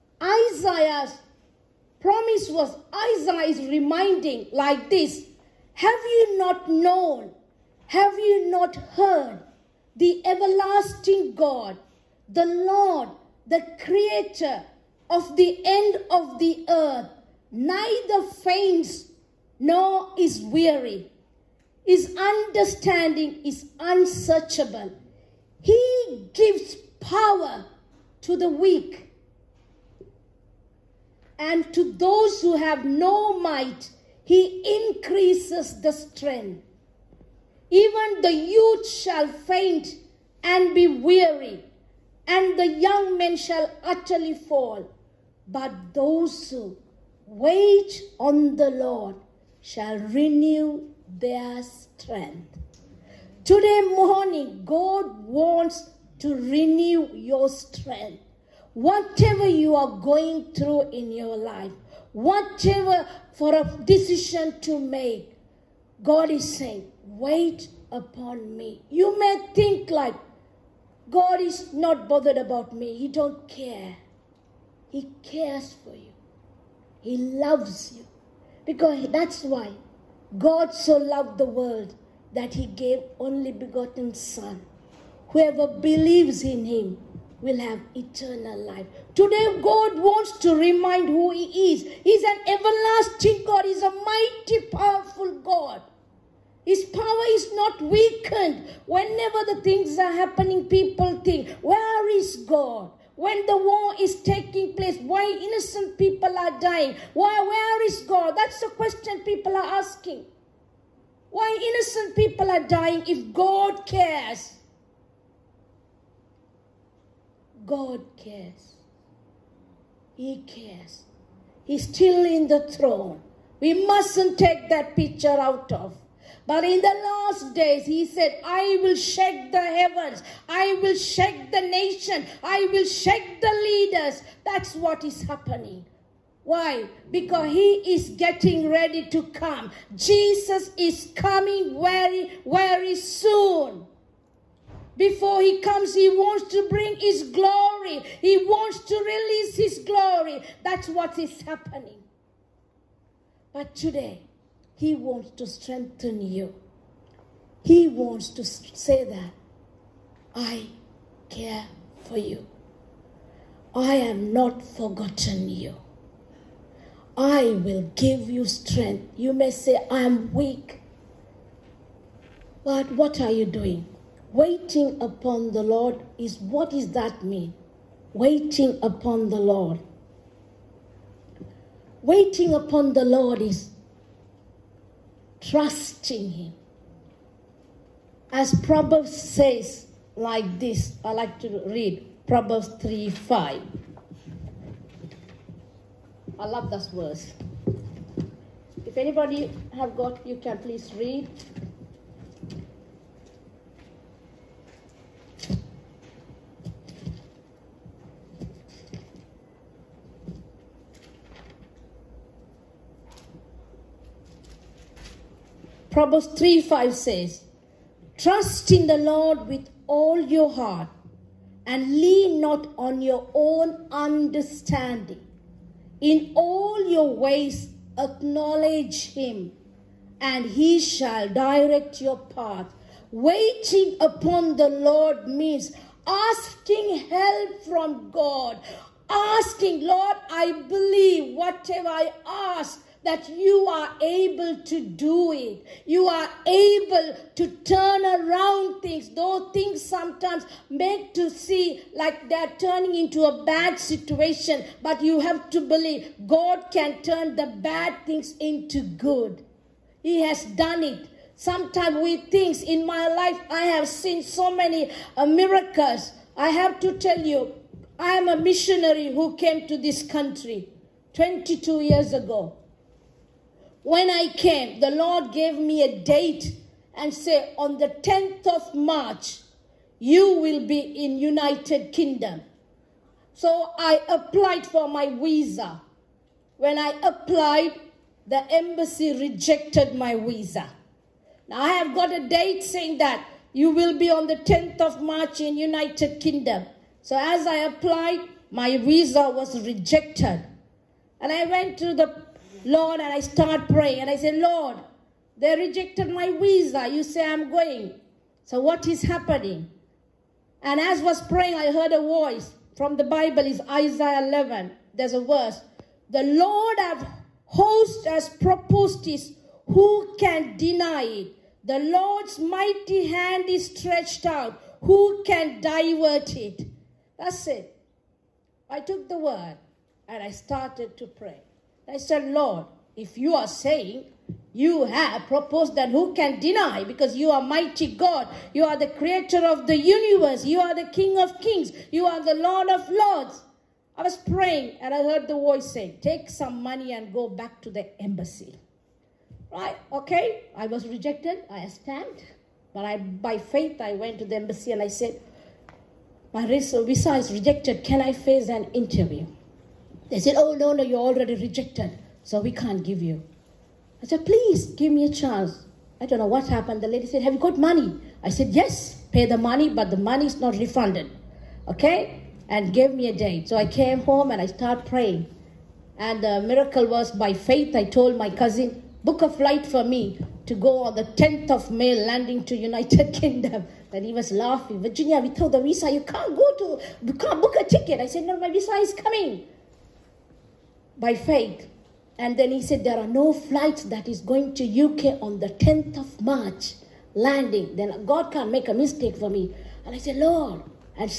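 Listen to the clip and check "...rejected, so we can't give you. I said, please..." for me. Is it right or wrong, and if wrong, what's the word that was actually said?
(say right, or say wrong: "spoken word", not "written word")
right.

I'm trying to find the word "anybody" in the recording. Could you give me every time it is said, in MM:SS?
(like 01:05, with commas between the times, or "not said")
03:18.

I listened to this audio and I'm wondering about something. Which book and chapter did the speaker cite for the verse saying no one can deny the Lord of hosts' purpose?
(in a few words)
Isaiah 11.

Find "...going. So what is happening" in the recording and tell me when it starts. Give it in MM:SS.
05:07.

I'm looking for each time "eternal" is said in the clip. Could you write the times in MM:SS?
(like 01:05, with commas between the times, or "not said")
01:27.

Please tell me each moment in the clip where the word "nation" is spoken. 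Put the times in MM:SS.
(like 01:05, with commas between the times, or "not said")
02:11.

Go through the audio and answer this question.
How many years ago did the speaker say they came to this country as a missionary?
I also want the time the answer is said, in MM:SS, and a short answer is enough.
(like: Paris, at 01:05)
22 years, at 04:31.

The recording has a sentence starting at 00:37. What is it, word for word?
Even the youth shall faint and be weary, and the young men shall utterly fall.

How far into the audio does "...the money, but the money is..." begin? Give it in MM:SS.
06:09.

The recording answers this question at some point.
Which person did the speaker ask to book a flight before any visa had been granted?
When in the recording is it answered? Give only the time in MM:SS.
06:18.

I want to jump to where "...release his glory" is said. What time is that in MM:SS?
02:28.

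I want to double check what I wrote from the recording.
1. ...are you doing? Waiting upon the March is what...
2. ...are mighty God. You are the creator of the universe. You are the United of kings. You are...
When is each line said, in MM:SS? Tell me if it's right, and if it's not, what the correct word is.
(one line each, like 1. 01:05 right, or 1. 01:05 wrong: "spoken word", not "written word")
1. 02:53 wrong: "Lord", not "March"
2. 05:37 wrong: "King", not "United".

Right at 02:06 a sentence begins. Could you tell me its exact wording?
But in the last days, he said, I will shake the heavens.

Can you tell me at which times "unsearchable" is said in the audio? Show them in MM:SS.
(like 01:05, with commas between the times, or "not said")
00:23.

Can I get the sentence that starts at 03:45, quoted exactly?
In all your ways acknowledge him, and he shall direct your path.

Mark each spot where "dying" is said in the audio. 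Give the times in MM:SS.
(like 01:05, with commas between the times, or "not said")
01:46, 01:52.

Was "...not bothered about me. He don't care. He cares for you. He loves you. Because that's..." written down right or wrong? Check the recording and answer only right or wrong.
right.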